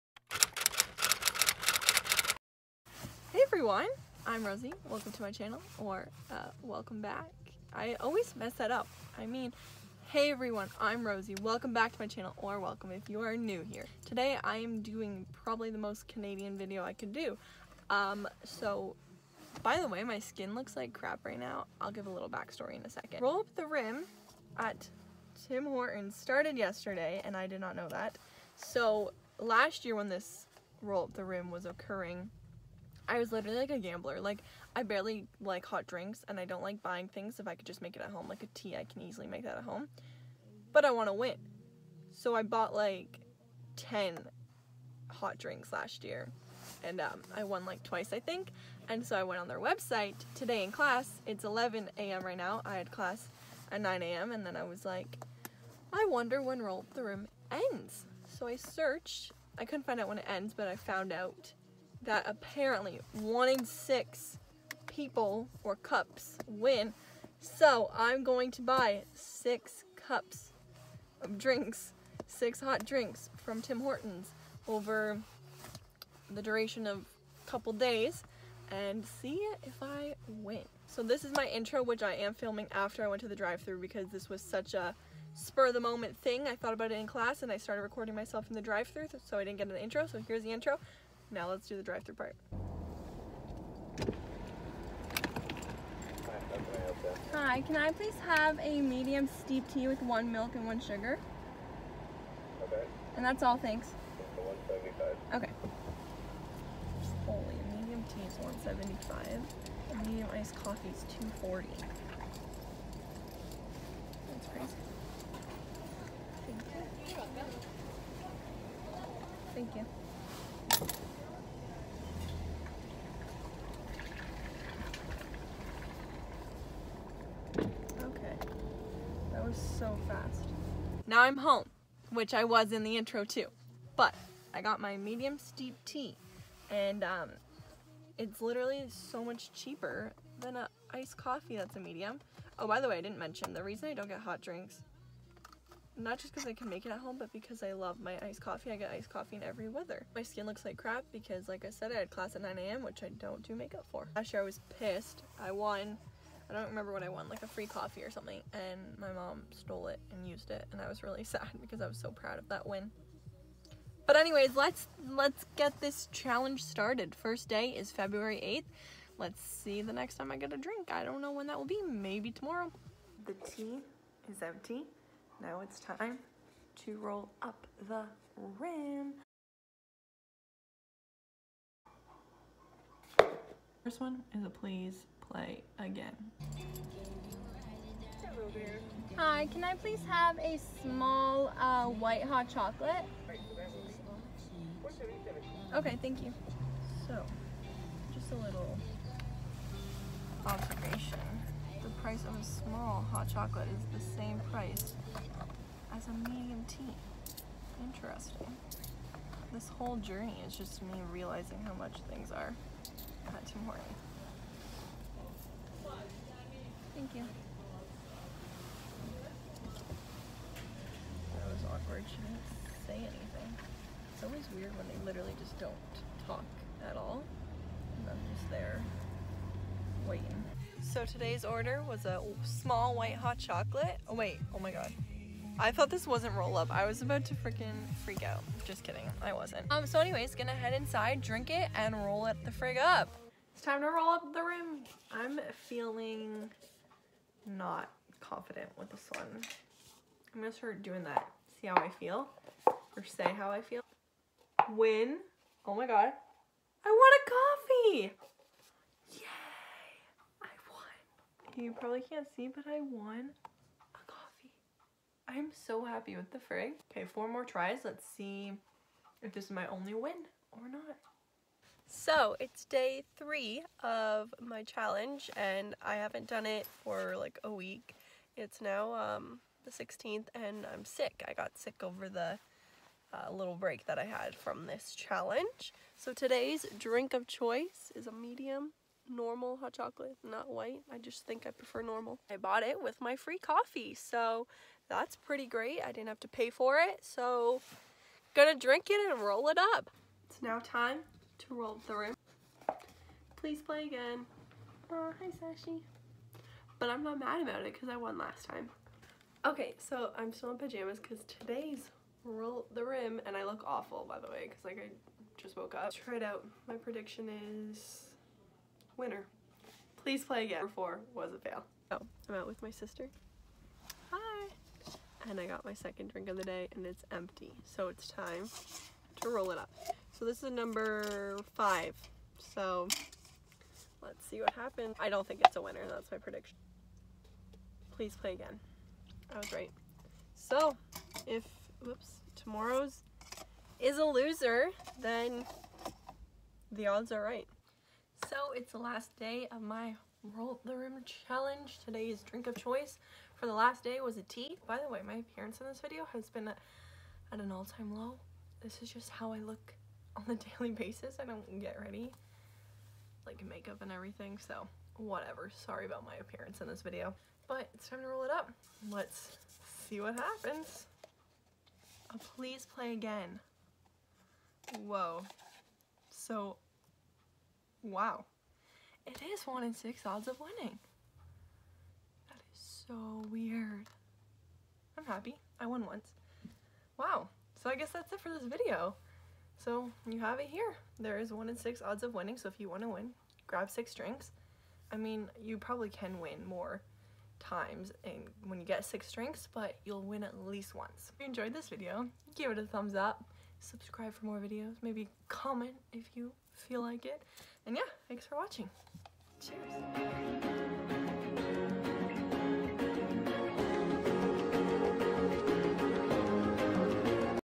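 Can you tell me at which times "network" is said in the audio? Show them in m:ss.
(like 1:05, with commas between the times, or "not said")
not said.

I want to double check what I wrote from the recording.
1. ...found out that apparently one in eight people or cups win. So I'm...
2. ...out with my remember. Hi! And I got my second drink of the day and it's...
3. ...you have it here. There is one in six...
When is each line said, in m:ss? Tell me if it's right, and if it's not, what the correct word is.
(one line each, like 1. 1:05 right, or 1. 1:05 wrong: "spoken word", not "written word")
1. 1:00 wrong: "six", not "eight"
2. 5:22 wrong: "sister", not "remember"
3. 6:30 right.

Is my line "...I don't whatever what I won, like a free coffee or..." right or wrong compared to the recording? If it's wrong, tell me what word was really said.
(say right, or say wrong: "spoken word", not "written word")
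wrong: "remember", not "whatever".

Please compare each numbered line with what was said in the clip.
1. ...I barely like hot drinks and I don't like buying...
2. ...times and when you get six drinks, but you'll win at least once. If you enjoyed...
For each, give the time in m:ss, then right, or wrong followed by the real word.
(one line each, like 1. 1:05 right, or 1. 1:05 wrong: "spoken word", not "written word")
1. 0:34 right
2. 6:37 right.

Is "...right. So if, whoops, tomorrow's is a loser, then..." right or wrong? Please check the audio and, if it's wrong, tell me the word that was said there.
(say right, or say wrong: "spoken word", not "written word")
right.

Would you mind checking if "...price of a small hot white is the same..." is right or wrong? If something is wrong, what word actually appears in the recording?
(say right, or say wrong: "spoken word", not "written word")
wrong: "chocolate", not "white".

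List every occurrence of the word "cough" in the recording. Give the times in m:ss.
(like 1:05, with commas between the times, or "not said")
not said.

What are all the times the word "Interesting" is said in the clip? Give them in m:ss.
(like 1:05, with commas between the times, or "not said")
3:27.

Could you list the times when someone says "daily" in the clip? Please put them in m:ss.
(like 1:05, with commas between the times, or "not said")
6:00.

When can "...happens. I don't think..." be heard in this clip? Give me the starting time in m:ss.
5:34.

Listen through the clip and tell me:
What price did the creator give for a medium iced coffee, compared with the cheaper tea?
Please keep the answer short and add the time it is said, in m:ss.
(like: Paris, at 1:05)
2.40, at 1:51.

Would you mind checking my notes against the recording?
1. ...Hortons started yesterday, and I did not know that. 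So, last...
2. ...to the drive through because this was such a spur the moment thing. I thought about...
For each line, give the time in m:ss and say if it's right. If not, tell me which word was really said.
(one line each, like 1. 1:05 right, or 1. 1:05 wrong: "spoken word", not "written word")
1. 0:25 right
2. 1:23 right.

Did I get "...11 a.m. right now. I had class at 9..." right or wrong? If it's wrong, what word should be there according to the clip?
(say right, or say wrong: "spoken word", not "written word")
right.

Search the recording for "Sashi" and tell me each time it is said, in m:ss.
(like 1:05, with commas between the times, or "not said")
5:05.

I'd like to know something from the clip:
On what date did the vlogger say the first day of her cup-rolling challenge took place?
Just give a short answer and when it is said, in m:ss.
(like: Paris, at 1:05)
February 8th, at 2:47.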